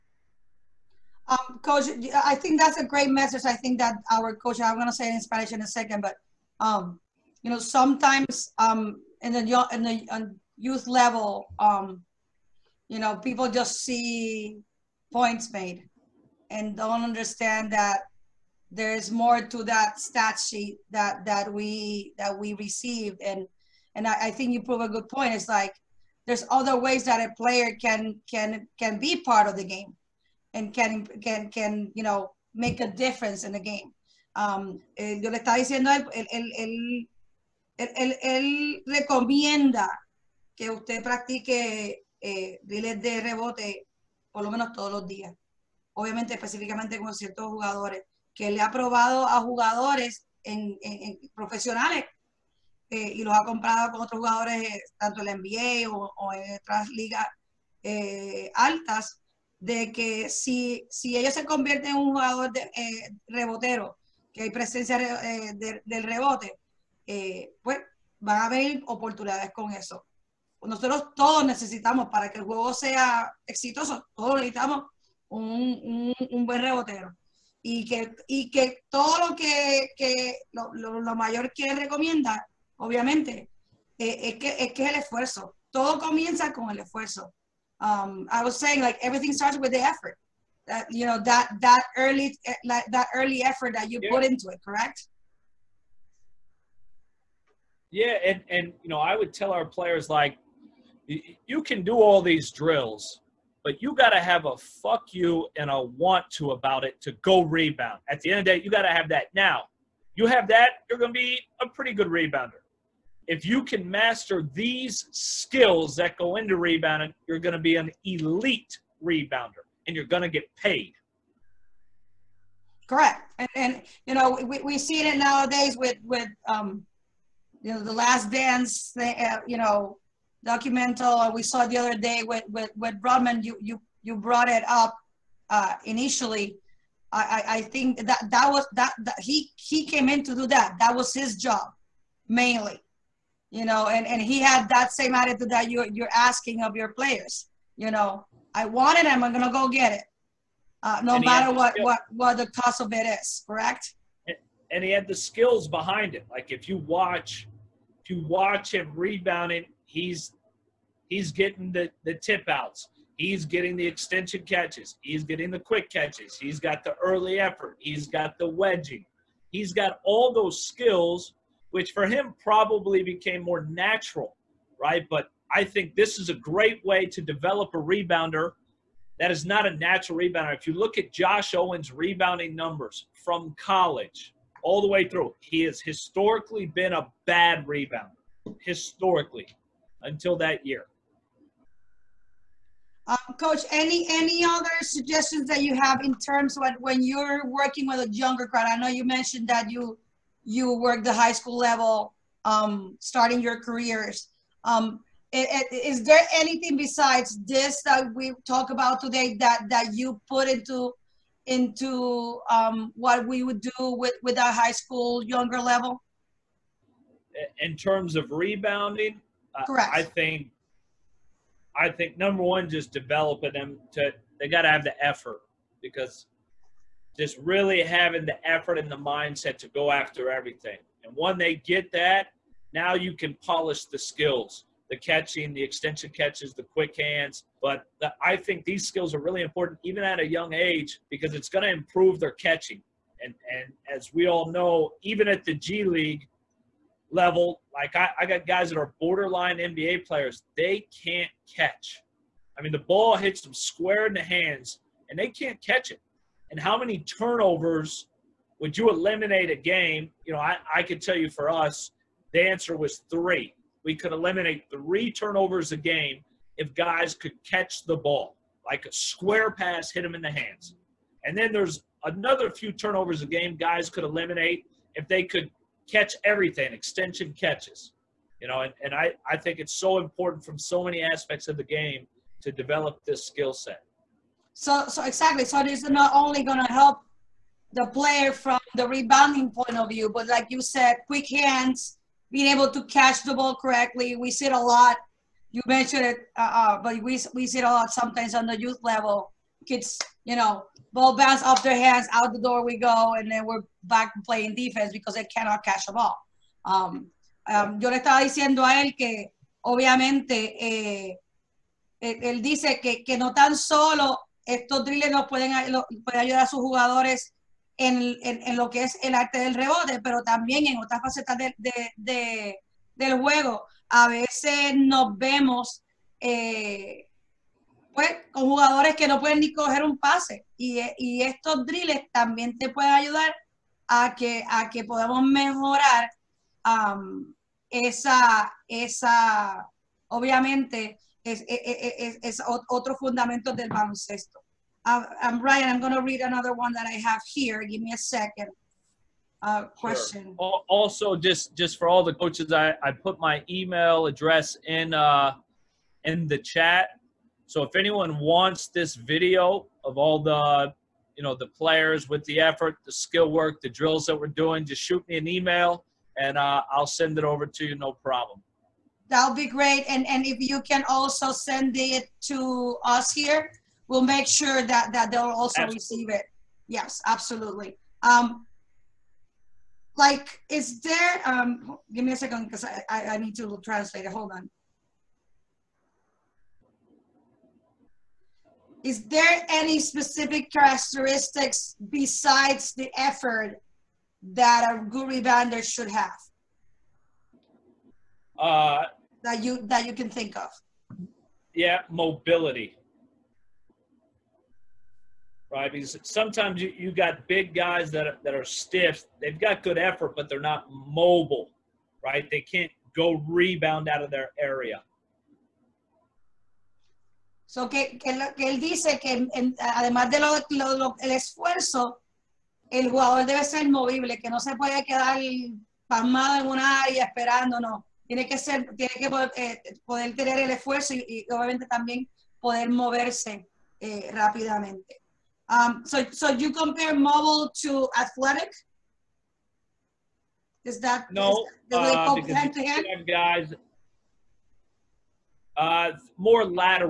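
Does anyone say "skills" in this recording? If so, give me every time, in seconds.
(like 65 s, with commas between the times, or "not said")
115 s, 155 s, 170 s, 233 s, 238 s, 283 s, 362 s.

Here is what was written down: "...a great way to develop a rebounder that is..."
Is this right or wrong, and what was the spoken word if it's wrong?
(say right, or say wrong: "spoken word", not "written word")
right.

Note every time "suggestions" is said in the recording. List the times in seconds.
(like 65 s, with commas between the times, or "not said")
194 s.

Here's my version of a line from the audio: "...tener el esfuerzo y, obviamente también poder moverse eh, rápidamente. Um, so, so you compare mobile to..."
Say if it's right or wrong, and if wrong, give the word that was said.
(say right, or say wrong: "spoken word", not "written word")
right.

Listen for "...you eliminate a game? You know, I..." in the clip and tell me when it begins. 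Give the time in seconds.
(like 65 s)
258 s.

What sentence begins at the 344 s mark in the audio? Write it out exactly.
Uh, um, um Ryan, I'm going to read another one that I have here.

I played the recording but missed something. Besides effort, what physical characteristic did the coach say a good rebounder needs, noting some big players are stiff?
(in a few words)
Mobility.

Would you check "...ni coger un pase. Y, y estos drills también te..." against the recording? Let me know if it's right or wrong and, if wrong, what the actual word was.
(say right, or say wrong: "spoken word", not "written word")
right.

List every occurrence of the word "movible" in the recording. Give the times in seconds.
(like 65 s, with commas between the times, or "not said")
423 s.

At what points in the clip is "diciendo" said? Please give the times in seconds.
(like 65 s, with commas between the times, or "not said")
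35 s, 308 s.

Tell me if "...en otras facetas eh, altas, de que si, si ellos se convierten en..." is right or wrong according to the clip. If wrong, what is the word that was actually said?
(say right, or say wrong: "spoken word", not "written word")
wrong: "ligas", not "facetas".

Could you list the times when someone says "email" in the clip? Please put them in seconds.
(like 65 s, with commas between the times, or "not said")
353 s, 365 s.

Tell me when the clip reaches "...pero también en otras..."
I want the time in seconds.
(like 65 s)
320 s.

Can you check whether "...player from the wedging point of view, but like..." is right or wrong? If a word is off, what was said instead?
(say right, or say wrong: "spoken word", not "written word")
wrong: "rebounding", not "wedging".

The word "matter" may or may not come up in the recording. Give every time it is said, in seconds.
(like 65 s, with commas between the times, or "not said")
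151 s.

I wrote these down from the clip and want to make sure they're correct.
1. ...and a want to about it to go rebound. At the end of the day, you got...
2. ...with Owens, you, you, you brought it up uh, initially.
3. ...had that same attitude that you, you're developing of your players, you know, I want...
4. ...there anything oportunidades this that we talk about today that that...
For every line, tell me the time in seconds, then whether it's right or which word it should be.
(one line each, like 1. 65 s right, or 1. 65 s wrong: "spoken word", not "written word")
1. 105 s right
2. 132 s wrong: "Rodman", not "Owens"
3. 144 s wrong: "asking", not "developing"
4. 206 s wrong: "besides", not "oportunidades".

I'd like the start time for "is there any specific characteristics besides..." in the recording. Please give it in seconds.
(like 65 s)
388 s.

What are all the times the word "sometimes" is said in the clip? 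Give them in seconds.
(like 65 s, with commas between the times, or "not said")
7 s, 297 s, 406 s.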